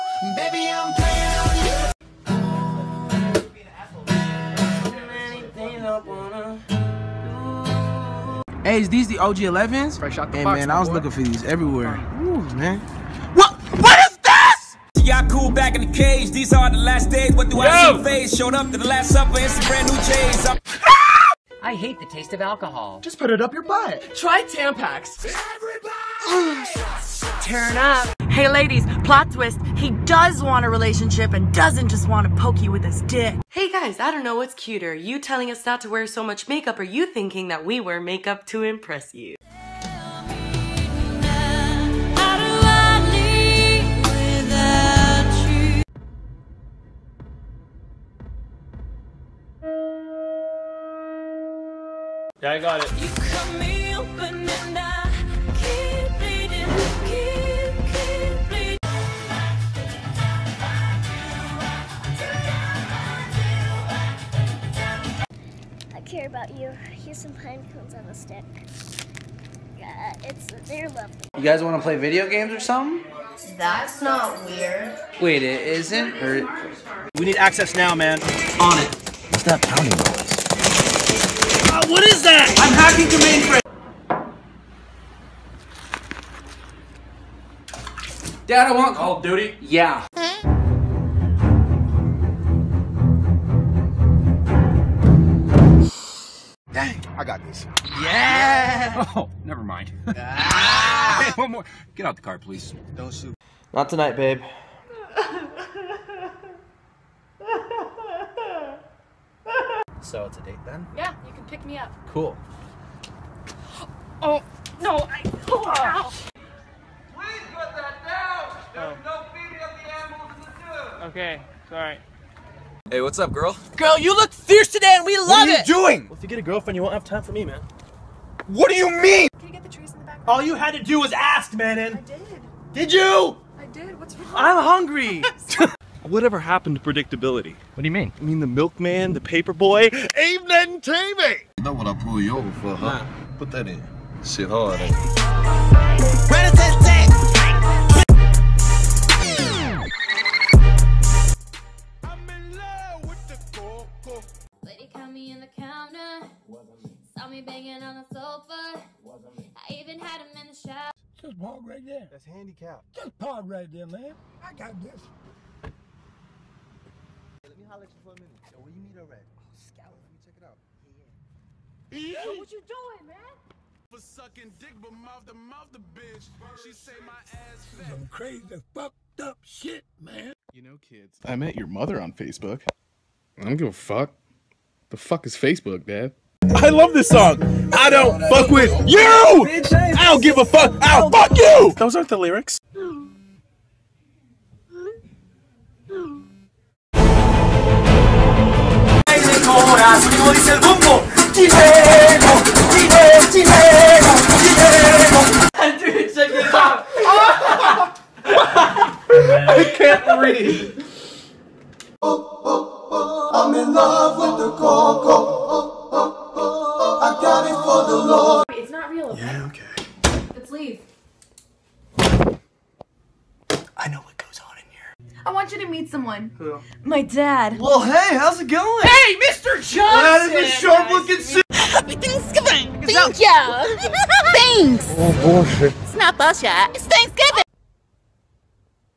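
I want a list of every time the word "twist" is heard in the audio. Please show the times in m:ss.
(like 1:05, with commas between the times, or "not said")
0:29.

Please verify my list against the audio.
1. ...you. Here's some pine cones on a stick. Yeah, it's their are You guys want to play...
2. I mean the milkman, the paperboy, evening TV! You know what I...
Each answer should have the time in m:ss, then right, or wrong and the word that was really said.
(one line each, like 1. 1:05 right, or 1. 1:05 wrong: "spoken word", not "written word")
1. 1:06 right
2. 2:18 right.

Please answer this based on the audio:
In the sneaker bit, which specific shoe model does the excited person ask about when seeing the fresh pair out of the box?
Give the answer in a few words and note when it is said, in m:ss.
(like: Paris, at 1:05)
OG 11s, at 0:09.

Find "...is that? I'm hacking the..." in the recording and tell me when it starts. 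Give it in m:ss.
1:22.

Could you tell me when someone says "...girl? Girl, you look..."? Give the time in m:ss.
2:03.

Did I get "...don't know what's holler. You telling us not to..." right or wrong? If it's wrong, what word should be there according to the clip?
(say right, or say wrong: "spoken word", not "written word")
wrong: "cuter", not "holler".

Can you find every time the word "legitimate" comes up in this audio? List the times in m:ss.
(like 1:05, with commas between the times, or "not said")
not said.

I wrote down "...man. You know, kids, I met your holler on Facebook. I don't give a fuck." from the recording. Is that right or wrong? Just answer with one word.
wrong.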